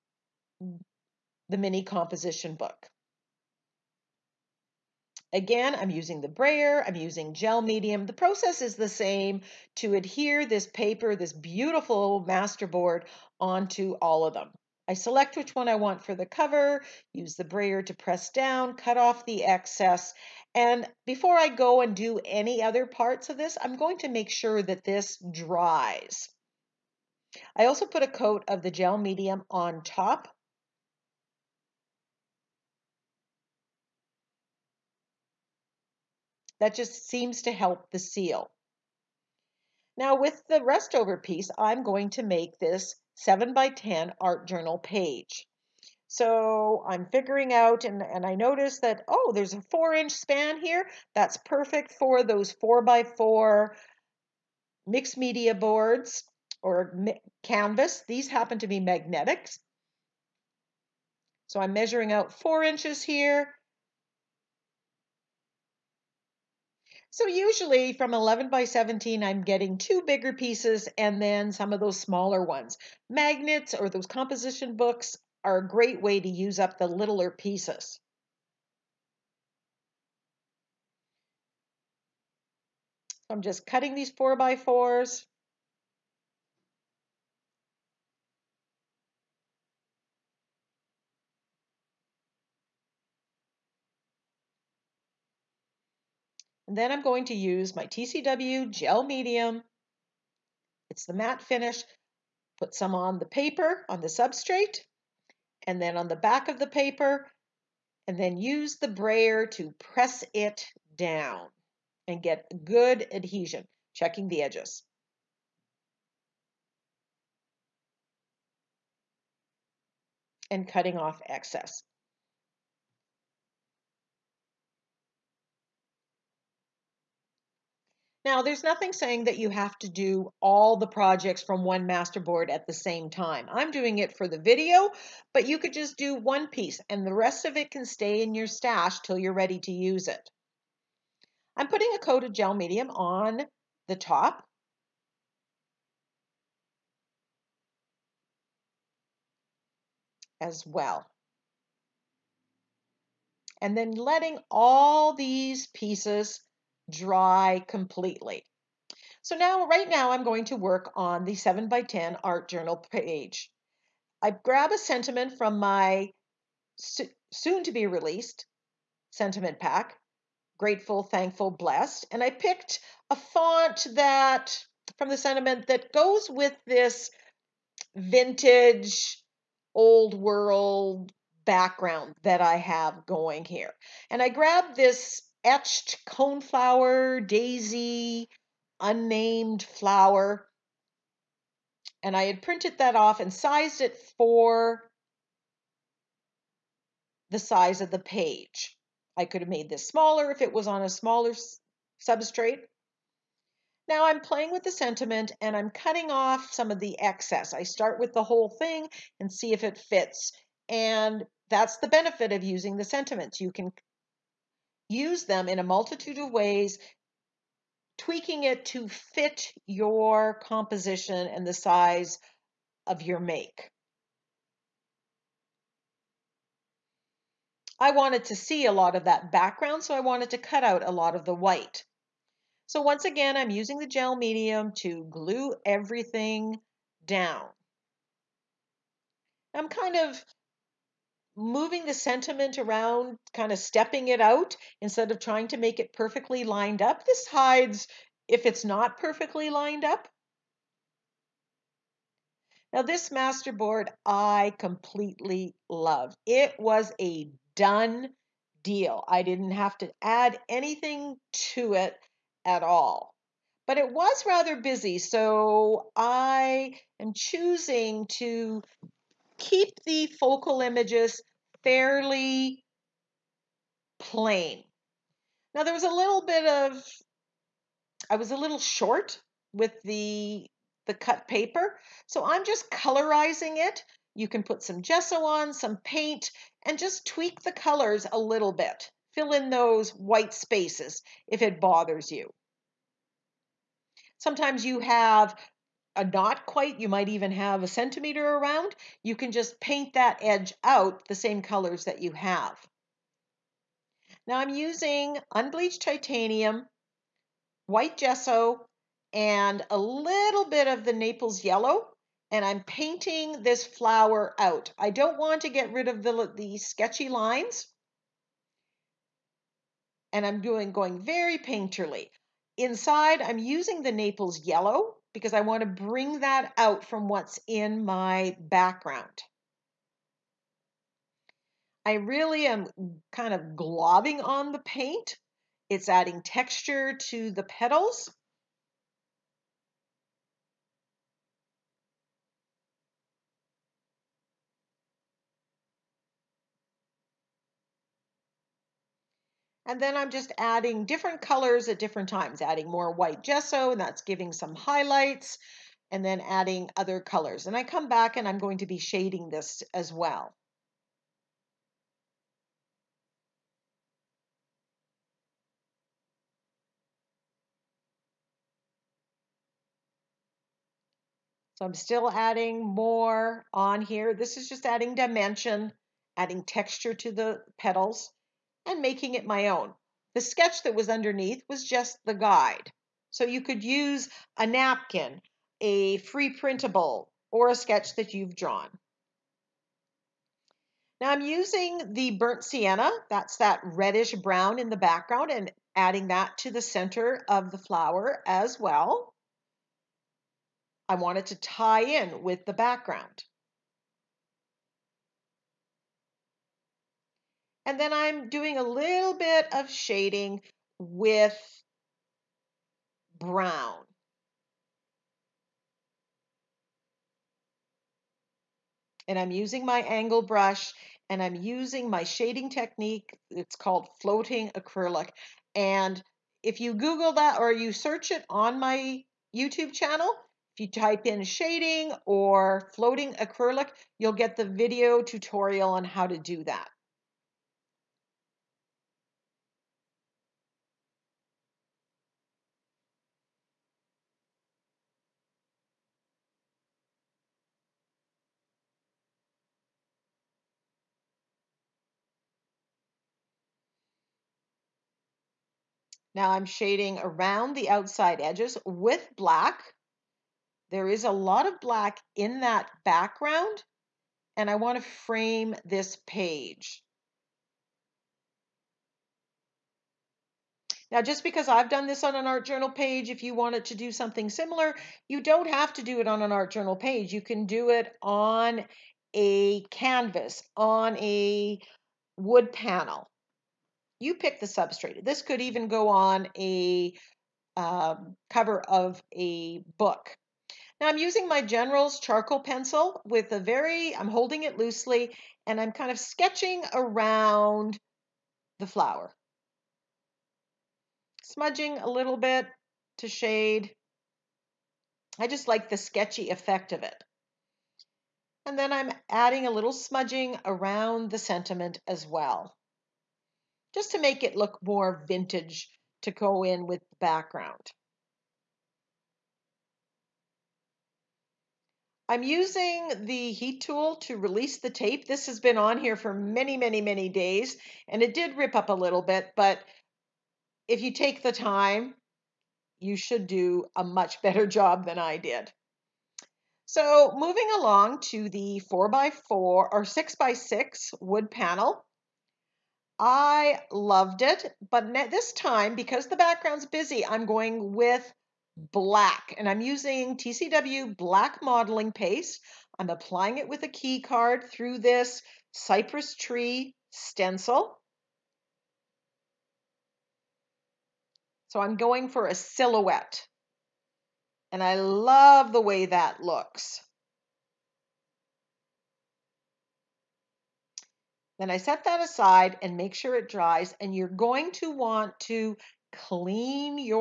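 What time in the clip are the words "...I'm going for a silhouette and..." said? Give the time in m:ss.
9:21.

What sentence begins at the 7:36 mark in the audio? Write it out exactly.
Now I'm shading around the outside edges with black.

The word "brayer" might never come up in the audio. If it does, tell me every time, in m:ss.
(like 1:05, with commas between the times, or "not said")
0:06, 0:17, 1:48.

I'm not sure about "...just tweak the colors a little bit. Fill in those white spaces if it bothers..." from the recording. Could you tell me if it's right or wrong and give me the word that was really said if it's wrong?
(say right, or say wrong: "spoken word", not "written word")
right.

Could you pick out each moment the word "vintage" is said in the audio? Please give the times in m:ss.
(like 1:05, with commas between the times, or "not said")
2:57, 8:35.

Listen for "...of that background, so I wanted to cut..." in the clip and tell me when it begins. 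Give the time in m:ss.
3:48.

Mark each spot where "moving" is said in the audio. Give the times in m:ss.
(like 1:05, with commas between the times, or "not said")
4:01, 8:57.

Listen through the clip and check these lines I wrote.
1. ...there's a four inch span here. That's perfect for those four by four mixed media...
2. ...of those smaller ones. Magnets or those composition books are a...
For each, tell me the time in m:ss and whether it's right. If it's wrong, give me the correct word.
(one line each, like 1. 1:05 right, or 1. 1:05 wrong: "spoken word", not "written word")
1. 0:49 right
2. 1:11 right.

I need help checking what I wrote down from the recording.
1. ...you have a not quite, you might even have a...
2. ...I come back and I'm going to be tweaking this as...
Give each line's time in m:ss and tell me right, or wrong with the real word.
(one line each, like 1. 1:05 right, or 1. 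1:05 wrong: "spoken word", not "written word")
1. 4:54 right
2. 5:57 wrong: "shading", not "tweaking".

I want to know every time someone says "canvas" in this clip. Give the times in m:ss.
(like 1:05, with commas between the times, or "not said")
0:57, 7:59.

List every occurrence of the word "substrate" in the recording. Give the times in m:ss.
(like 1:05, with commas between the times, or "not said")
1:44, 3:22, 8:04.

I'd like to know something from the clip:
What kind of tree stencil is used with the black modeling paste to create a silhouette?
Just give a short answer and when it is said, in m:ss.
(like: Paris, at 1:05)
cypress, at 9:15.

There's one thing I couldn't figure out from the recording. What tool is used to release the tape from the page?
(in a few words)
heat tool.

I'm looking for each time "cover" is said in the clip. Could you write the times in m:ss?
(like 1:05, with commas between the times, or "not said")
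0:16, 8:08.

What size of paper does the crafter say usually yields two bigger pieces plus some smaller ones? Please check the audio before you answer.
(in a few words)
11 by 17.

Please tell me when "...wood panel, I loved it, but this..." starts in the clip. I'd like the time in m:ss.
9:01.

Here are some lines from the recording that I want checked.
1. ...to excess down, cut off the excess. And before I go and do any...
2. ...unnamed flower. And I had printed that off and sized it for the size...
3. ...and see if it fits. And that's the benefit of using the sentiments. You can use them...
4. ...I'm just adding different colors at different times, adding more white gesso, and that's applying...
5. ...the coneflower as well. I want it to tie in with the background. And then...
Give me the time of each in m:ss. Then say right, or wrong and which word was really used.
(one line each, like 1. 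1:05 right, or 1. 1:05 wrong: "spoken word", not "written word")
1. 0:17 wrong: "press", not "excess"
2. 3:08 right
3. 3:29 right
4. 5:49 wrong: "giving", not "applying"
5. 6:37 wrong: "flower", not "coneflower".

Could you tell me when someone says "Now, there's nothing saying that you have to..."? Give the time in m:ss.
2:08.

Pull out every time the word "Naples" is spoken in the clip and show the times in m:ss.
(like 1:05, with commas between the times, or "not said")
5:10, 5:23.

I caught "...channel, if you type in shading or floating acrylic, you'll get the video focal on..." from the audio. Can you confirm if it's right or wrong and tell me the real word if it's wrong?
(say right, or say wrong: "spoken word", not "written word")
wrong: "tutorial", not "focal".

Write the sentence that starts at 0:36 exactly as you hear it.
That just seems to help the seal.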